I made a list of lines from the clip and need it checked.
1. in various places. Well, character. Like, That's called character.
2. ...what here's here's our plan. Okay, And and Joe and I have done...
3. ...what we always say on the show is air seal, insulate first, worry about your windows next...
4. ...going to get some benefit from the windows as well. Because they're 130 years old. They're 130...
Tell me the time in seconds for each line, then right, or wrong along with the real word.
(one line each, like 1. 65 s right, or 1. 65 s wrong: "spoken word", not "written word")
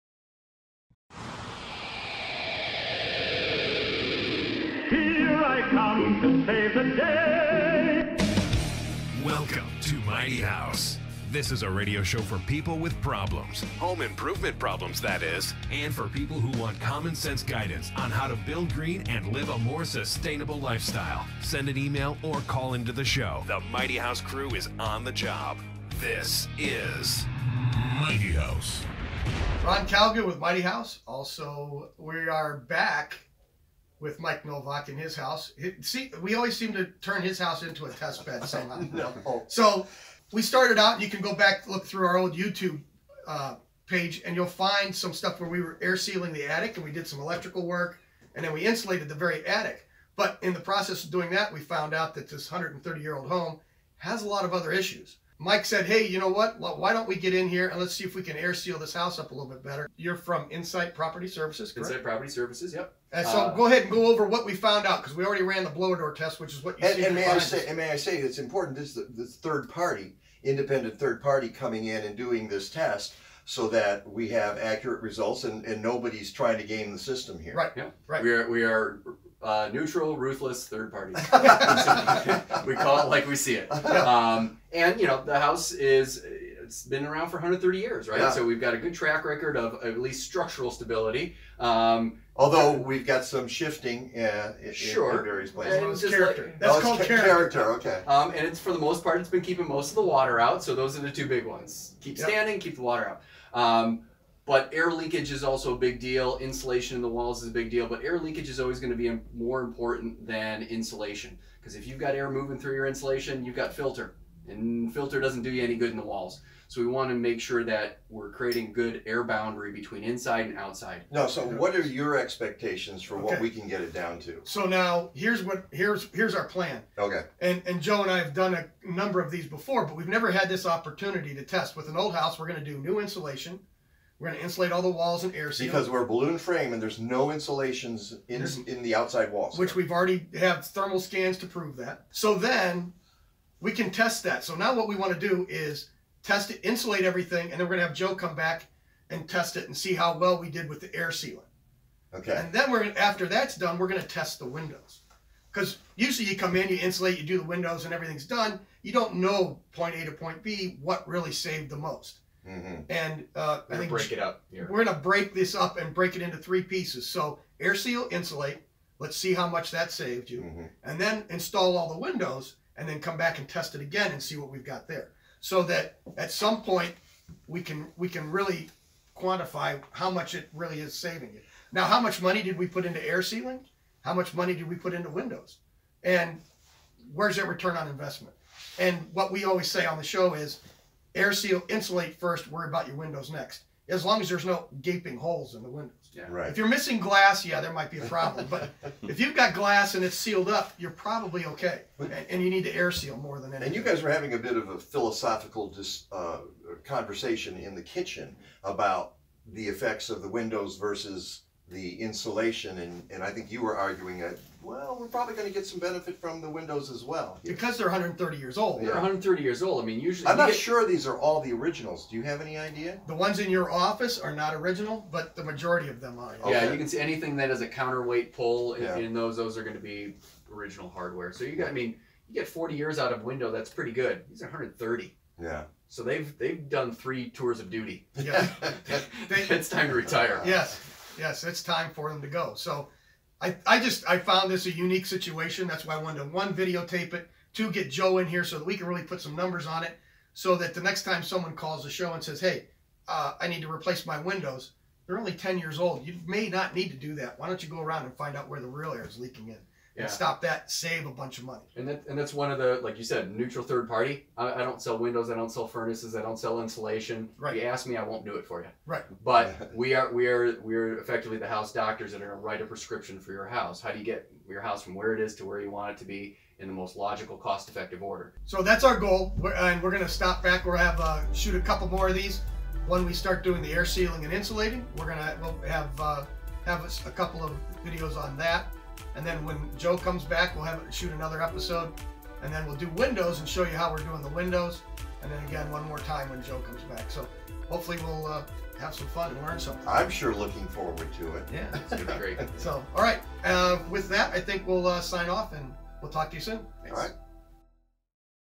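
1. 95 s right
2. 125 s right
3. 189 s right
4. 215 s right.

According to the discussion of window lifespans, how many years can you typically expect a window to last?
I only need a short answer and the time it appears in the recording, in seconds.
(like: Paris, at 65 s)
40, at 232 s.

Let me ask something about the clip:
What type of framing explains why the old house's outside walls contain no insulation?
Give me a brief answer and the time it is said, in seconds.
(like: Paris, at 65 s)
Balloon frame, at 136 s.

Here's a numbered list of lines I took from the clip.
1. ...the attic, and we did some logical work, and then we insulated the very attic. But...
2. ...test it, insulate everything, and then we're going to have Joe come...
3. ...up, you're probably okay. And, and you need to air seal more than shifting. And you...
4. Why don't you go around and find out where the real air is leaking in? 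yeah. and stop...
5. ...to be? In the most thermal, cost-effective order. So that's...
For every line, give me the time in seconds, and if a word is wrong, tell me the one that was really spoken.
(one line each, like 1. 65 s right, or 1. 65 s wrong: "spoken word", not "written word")
1. 46 s wrong: "electrical", not "logical"
2. 146 s right
3. 200 s wrong: "anything", not "shifting"
4. 257 s right
5. 275 s wrong: "logical", not "thermal".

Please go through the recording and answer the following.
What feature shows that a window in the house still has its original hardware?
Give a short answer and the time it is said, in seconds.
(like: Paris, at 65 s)
Counterweight pull, at 227 s.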